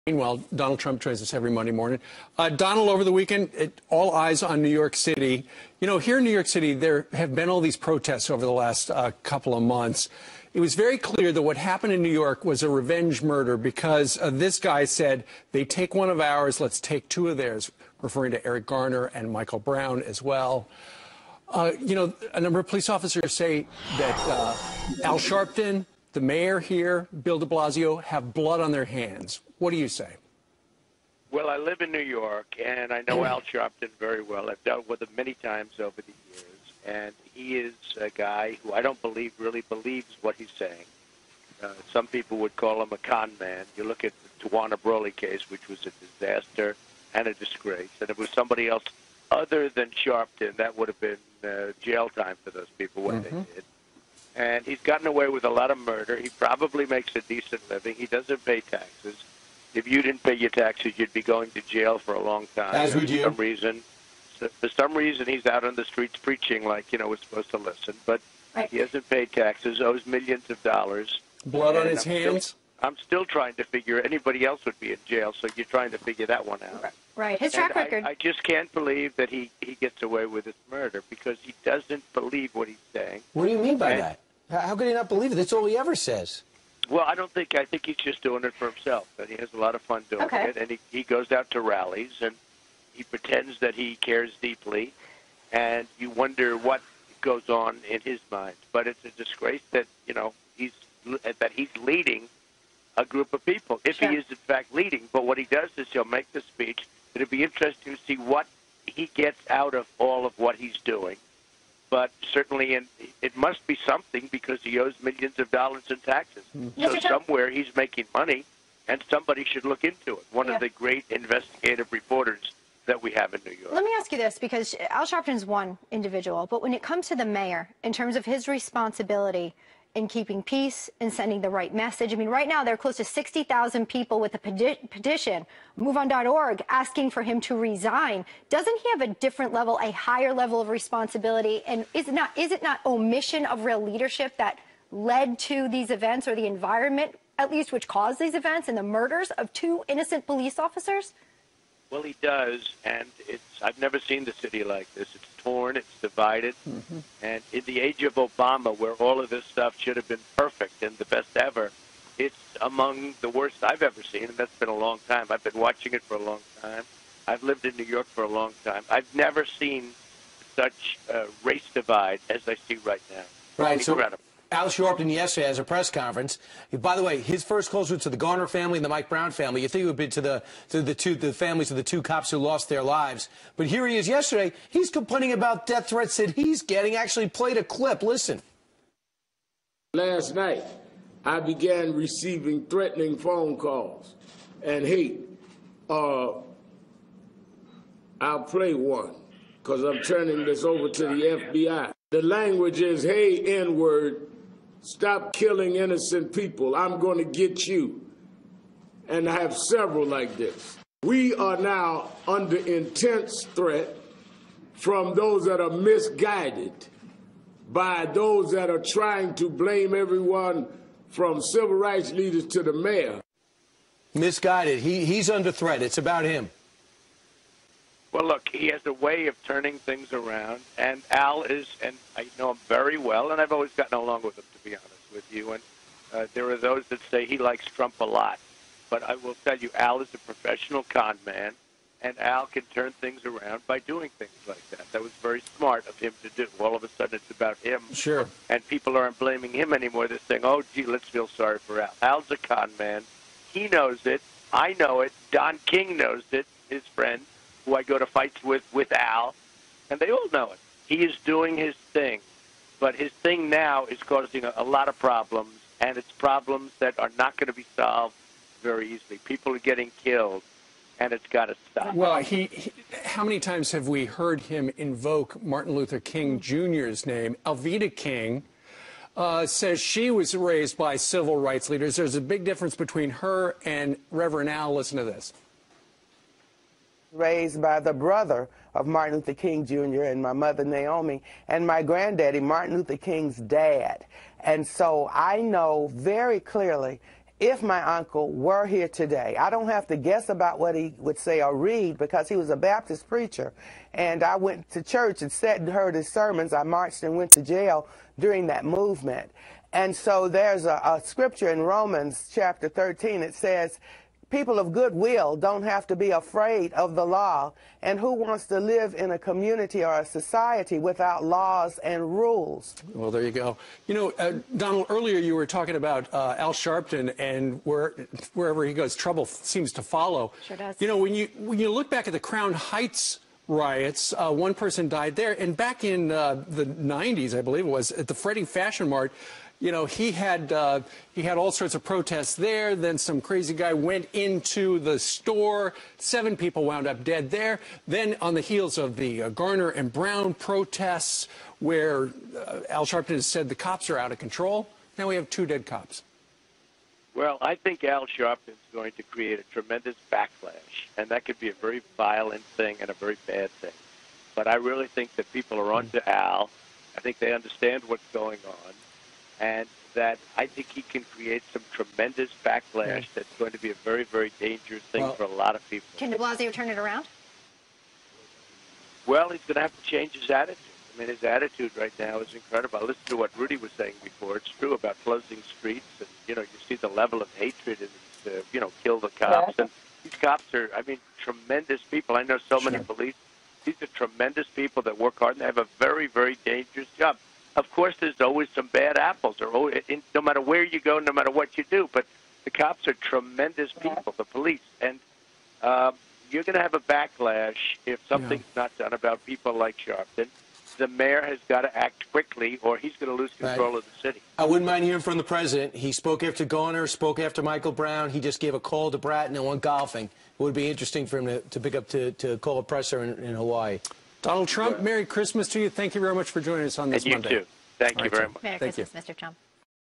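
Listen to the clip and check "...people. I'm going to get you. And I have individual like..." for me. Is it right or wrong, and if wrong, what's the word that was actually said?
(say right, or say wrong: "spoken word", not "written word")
wrong: "several", not "individual".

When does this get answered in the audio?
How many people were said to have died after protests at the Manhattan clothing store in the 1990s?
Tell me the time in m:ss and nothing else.
5:45.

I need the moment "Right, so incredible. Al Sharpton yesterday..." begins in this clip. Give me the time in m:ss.
2:53.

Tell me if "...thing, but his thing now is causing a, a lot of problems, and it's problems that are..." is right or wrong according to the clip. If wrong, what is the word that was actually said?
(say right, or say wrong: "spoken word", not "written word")
right.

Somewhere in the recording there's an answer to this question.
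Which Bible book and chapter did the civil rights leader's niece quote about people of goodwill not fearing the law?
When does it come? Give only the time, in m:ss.
5:11.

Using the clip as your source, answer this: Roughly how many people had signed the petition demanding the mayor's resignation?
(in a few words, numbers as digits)
60,000.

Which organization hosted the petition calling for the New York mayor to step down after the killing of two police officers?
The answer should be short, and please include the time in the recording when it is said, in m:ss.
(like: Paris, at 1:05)
MoveOn.org, at 2:15.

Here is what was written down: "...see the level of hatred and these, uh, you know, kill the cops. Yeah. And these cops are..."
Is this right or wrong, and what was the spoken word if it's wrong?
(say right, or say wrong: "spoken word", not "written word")
right.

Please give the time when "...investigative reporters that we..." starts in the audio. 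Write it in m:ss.
2:01.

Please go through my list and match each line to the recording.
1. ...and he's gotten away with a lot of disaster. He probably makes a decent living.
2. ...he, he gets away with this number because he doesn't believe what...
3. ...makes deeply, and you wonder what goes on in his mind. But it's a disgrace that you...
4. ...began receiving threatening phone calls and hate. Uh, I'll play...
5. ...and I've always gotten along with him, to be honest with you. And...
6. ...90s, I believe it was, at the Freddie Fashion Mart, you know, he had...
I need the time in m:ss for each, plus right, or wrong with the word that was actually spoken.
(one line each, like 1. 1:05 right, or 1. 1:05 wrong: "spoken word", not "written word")
1. 0:54 wrong: "murder", not "disaster"
2. 1:19 wrong: "murder", not "number"
3. 1:33 wrong: "cares", not "makes"
4. 3:11 right
5. 3:53 right
6. 5:36 right.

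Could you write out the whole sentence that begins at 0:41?
Uh, some people would call him a con man.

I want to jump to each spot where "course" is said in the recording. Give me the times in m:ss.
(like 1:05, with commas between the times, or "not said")
6:37.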